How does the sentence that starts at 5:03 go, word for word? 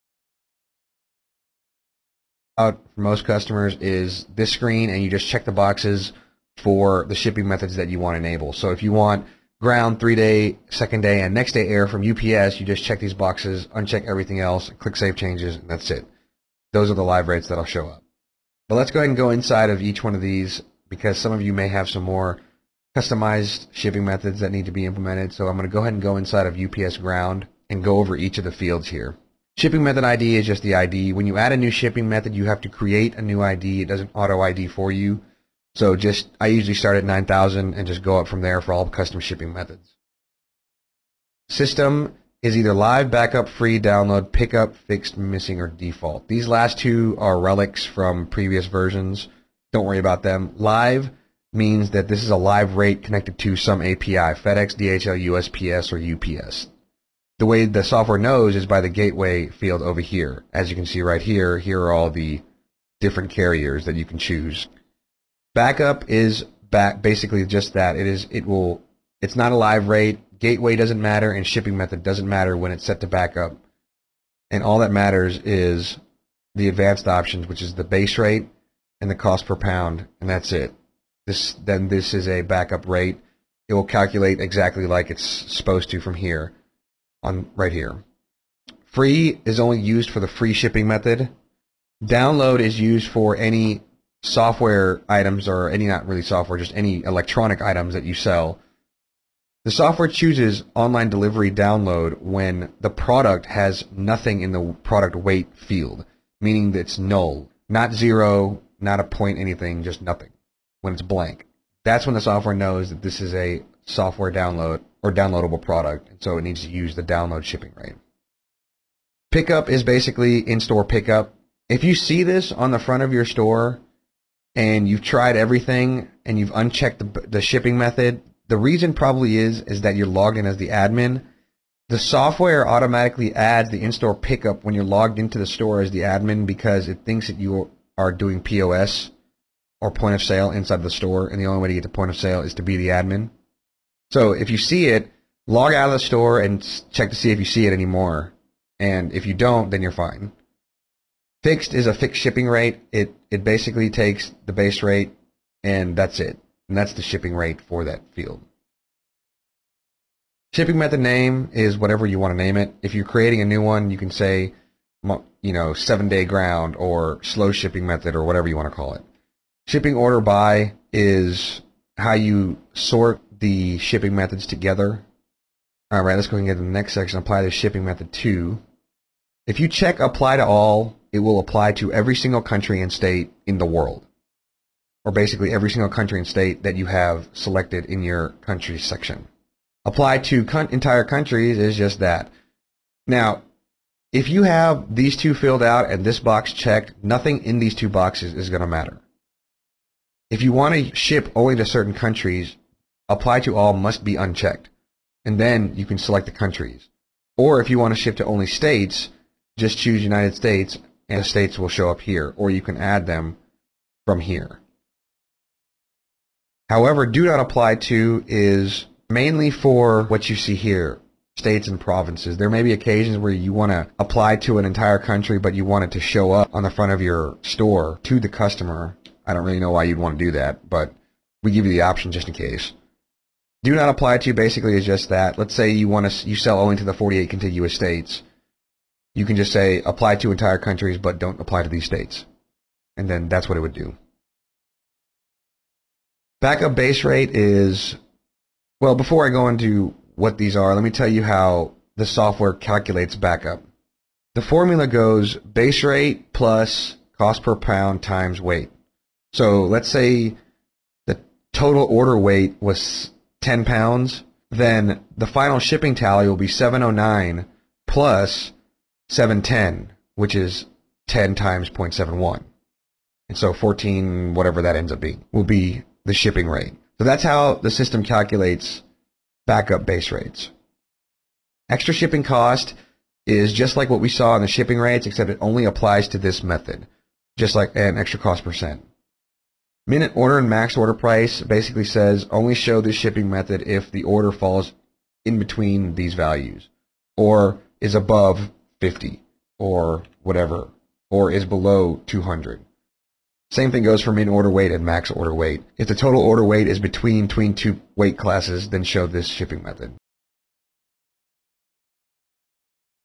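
Same thing goes for min order weight and max order weight.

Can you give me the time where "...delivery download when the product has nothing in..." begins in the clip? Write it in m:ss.
1:41.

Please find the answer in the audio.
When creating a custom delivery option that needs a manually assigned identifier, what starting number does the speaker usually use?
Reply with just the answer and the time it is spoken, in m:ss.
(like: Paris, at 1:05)
9000, at 0:37.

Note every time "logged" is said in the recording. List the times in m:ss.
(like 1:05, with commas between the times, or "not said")
2:10, 2:14.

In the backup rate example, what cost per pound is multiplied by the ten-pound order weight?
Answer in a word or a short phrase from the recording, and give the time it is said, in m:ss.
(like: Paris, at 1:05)
0.71, at 4:31.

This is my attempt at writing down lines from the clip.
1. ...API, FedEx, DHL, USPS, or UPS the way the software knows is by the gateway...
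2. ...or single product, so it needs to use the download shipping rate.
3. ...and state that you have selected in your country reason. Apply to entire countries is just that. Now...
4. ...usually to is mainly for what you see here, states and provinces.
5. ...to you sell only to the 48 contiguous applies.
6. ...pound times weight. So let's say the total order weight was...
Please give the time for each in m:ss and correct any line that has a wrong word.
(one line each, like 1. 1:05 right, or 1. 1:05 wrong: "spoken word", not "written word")
1. 0:53 right
2. 1:55 wrong: "downloadable", not "single"
3. 3:06 wrong: "section", not "reason"
4. 3:37 wrong: "apply", not "usually"
5. 3:56 wrong: "states", not "applies"
6. 4:17 right.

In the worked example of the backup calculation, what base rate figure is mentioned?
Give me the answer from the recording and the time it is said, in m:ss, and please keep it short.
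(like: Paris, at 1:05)
7.09, at 4:26.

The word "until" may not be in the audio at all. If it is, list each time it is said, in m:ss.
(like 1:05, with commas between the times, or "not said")
not said.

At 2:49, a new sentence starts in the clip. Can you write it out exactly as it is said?
Shipping order by is how you sort the shipping methods together.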